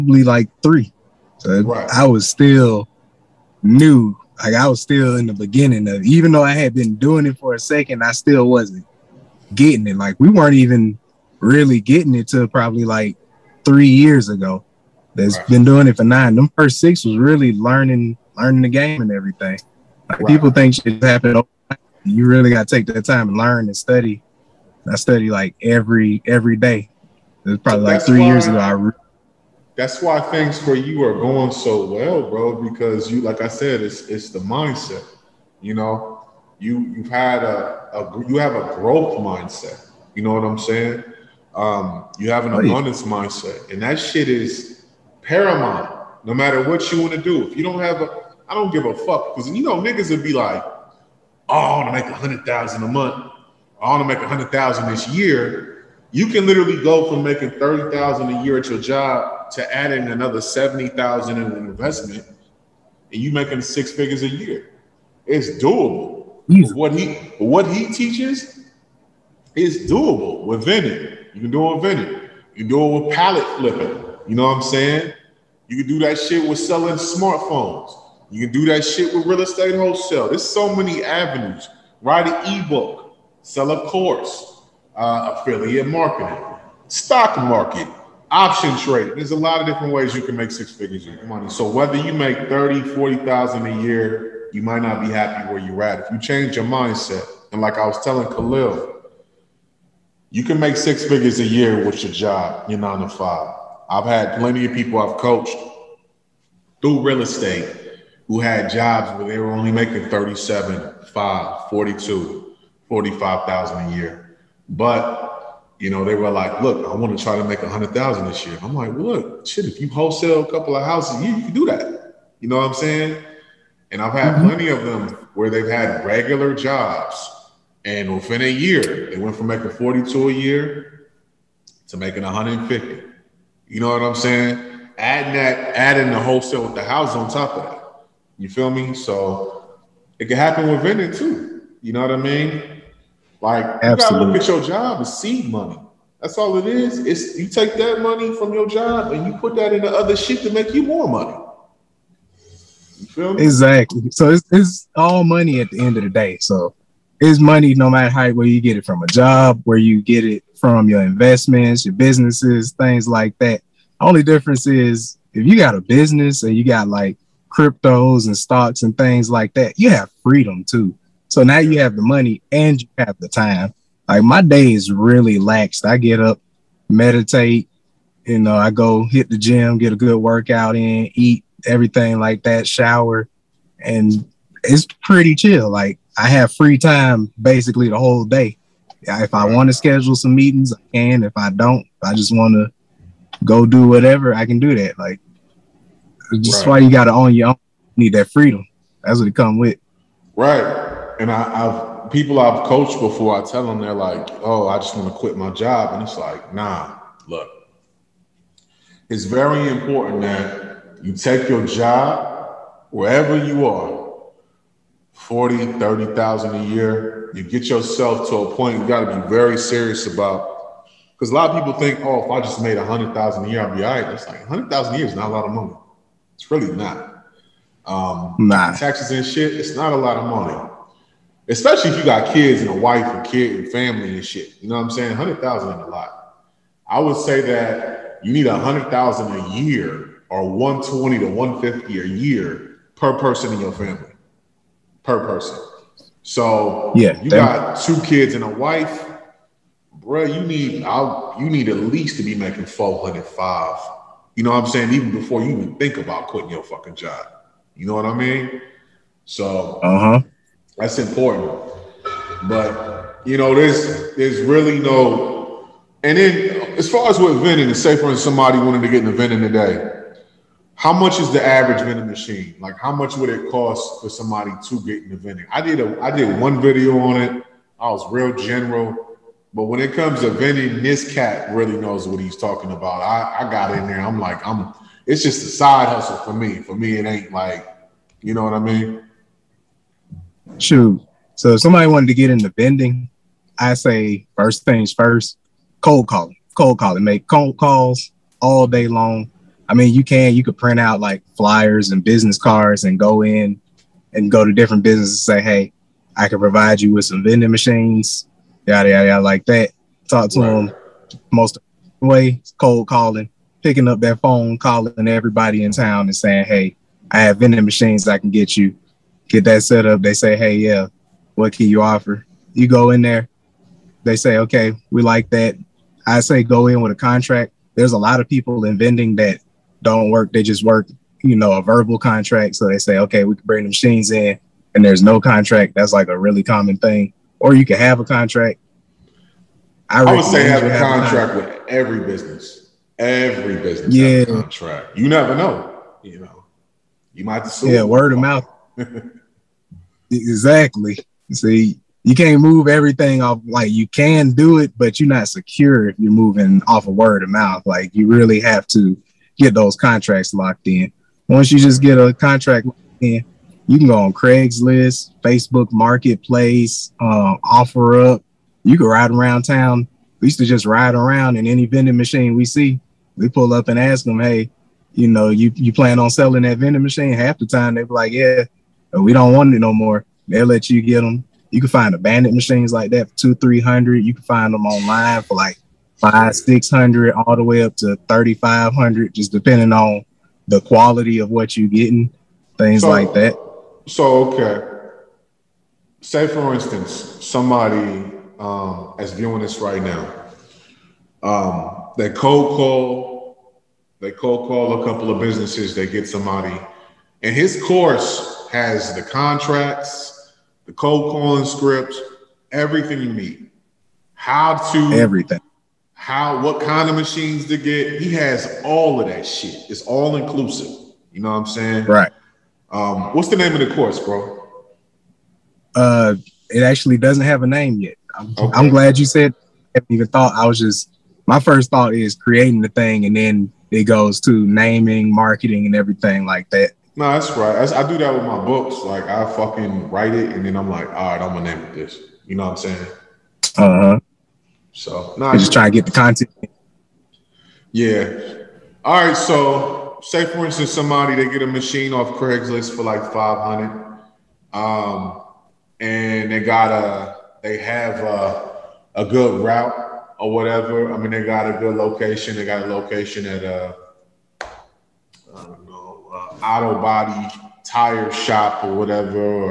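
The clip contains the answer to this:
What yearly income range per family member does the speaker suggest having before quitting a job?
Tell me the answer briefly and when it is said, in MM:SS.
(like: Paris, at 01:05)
120 to 150, at 04:00.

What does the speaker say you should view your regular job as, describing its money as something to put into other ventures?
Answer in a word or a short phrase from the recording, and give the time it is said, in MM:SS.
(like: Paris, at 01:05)
Seed money, at 02:25.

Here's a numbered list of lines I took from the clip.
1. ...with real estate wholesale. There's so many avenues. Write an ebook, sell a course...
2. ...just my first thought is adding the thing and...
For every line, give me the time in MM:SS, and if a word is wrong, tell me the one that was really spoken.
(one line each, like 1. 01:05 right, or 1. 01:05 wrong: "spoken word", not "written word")
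1. 01:19 right
2. 07:10 wrong: "creating", not "adding".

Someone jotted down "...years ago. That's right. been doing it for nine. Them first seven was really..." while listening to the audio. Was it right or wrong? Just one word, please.
wrong.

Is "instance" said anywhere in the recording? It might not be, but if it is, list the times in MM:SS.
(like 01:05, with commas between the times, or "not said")
04:28, 06:36, 07:30.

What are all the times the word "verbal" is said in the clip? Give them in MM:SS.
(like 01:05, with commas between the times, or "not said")
05:31.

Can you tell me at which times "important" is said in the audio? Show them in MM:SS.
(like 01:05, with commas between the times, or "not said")
03:29, 04:20.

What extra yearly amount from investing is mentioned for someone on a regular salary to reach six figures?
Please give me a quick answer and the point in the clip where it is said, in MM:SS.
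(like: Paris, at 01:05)
70,000, at 01:00.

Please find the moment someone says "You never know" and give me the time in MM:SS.
05:44.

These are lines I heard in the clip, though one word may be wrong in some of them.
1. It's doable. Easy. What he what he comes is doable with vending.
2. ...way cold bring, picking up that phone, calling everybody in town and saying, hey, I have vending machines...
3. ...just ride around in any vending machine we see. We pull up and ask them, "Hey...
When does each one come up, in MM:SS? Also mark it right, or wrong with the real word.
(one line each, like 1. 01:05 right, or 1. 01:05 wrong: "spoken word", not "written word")
1. 01:05 wrong: "teaches", not "comes"
2. 05:12 wrong: "calling", not "bring"
3. 06:10 right.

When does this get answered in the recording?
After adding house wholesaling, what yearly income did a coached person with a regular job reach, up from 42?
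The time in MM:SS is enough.
02:12.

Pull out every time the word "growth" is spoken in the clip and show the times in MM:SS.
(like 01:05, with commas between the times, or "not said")
00:38.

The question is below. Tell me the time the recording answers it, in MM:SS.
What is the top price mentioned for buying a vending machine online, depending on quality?
06:28.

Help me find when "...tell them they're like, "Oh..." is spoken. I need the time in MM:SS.
03:23.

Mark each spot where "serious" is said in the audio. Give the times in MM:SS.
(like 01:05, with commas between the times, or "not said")
03:39.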